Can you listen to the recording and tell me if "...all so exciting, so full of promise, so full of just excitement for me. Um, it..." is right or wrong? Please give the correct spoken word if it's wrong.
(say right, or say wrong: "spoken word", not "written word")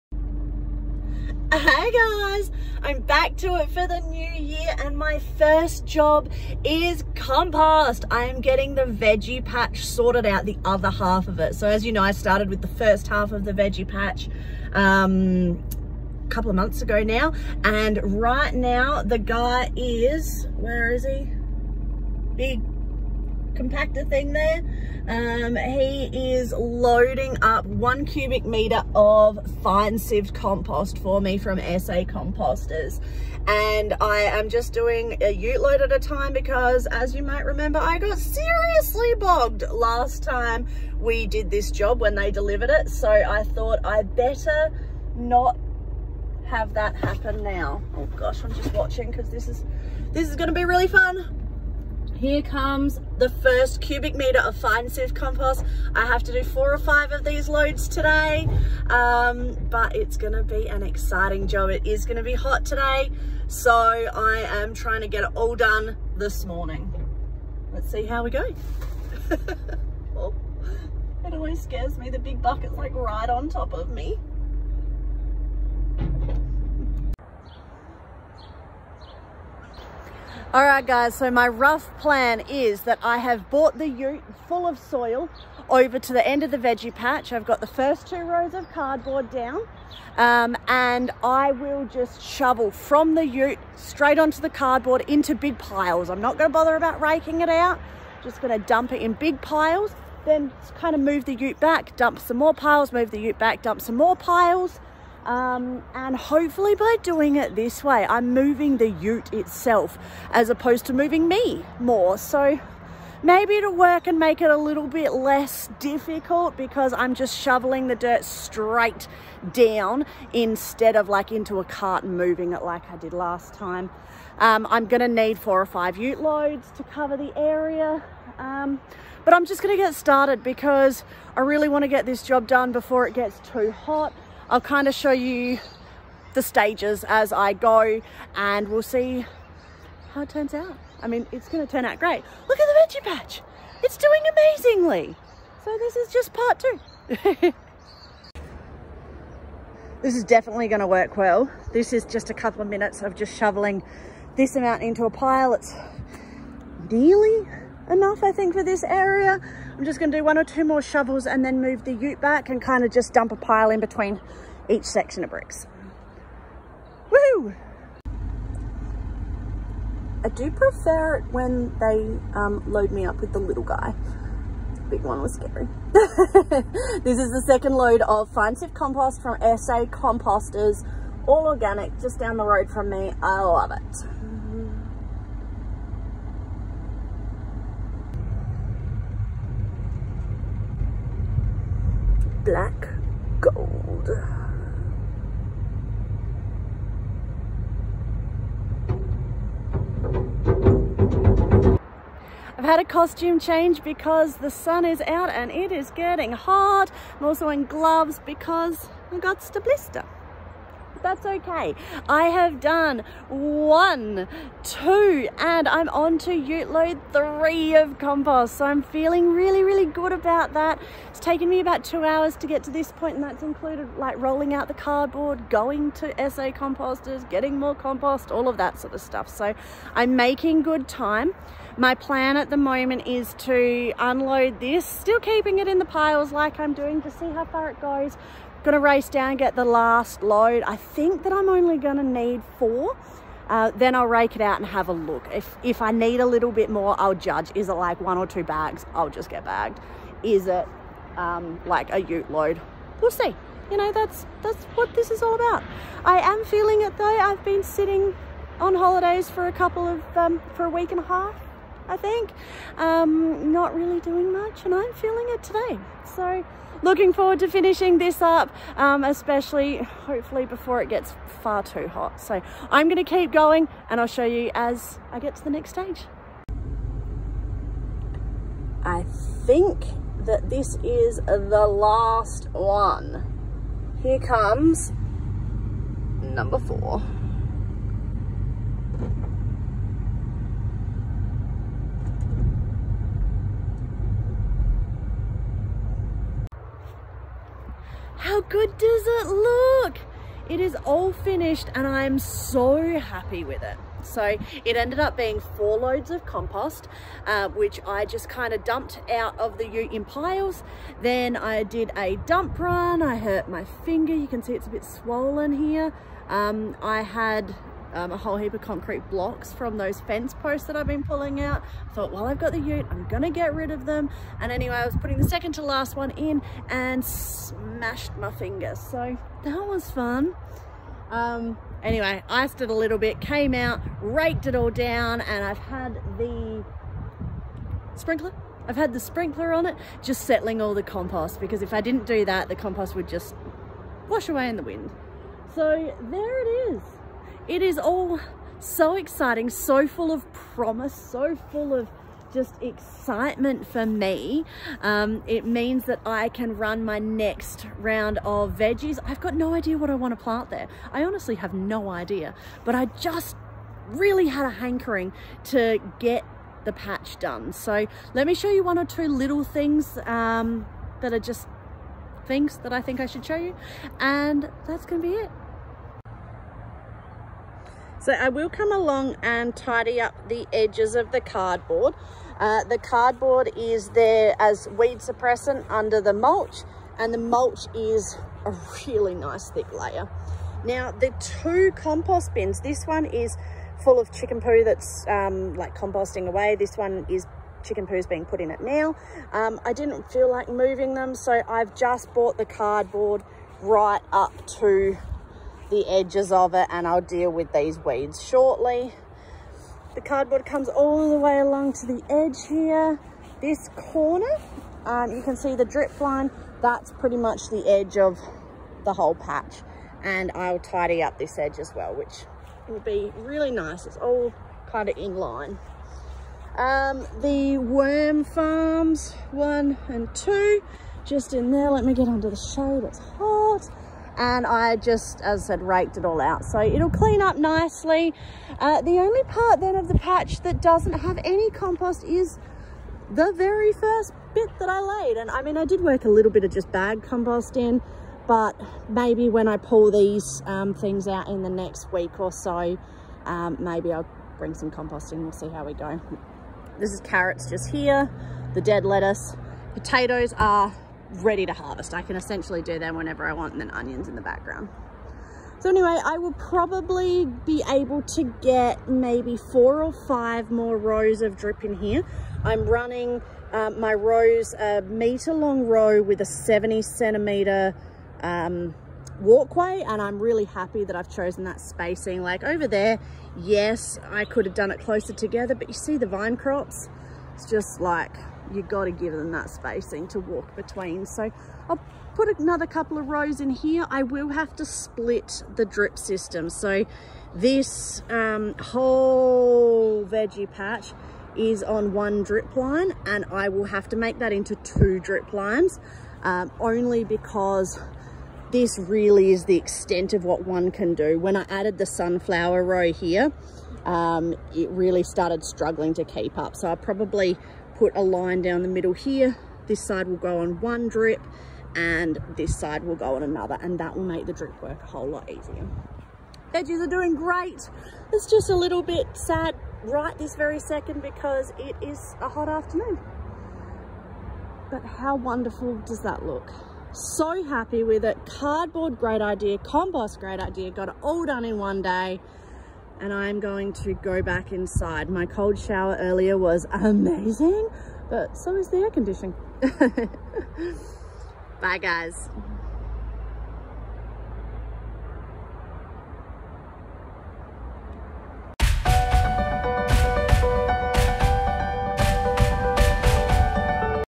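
right.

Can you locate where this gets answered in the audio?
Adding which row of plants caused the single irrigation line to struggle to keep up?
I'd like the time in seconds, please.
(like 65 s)
511 s.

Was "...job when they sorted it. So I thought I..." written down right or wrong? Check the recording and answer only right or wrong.
wrong.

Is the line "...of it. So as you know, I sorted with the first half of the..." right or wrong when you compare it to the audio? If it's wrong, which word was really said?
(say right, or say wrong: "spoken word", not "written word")
wrong: "started", not "sorted".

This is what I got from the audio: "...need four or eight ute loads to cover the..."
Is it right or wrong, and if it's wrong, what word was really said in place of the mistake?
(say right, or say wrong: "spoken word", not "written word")
wrong: "five", not "eight".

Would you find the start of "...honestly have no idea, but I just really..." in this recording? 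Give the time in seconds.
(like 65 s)
361 s.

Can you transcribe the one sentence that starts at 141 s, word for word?
I mean, it's going to turn out great.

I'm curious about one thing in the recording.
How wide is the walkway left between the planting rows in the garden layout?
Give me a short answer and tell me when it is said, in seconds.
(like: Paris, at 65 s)
70 centimeters, at 476 s.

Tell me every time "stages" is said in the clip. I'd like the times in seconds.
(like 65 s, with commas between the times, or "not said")
136 s, 275 s.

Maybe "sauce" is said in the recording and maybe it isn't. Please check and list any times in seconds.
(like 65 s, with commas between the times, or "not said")
not said.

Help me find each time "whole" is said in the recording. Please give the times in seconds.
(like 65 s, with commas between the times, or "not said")
318 s, 418 s, 498 s, 524 s.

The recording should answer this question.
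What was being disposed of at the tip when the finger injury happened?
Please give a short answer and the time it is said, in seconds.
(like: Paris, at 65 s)
Concrete blocks, at 318 s.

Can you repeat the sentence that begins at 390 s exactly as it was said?
Now the two compost bins, this one is full of chicken poo that's um, like composting away.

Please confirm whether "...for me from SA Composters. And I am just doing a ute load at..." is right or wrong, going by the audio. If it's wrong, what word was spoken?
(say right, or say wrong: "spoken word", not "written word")
right.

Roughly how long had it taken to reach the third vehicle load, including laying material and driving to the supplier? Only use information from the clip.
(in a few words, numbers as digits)
2 hours.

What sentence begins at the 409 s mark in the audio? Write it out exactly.
The cardboard comes all the way along to the edge here.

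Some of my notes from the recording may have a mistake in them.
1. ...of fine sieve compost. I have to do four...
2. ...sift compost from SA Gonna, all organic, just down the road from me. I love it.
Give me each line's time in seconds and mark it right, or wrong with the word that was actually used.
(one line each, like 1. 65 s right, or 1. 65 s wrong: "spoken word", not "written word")
1. 54 s right
2. 178 s wrong: "Composters", not "Gonna".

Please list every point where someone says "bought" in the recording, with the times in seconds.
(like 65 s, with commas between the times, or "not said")
83 s, 402 s.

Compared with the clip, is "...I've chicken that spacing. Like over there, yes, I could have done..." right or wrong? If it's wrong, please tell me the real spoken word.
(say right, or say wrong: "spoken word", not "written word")
wrong: "chosen", not "chicken".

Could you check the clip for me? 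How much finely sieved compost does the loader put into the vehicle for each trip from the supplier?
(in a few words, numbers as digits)
1 cubic meter.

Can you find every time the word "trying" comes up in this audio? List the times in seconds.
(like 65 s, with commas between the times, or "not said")
64 s.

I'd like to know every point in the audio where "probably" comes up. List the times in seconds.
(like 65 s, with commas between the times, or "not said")
466 s, 516 s.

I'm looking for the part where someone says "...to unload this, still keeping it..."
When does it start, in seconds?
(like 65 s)
233 s.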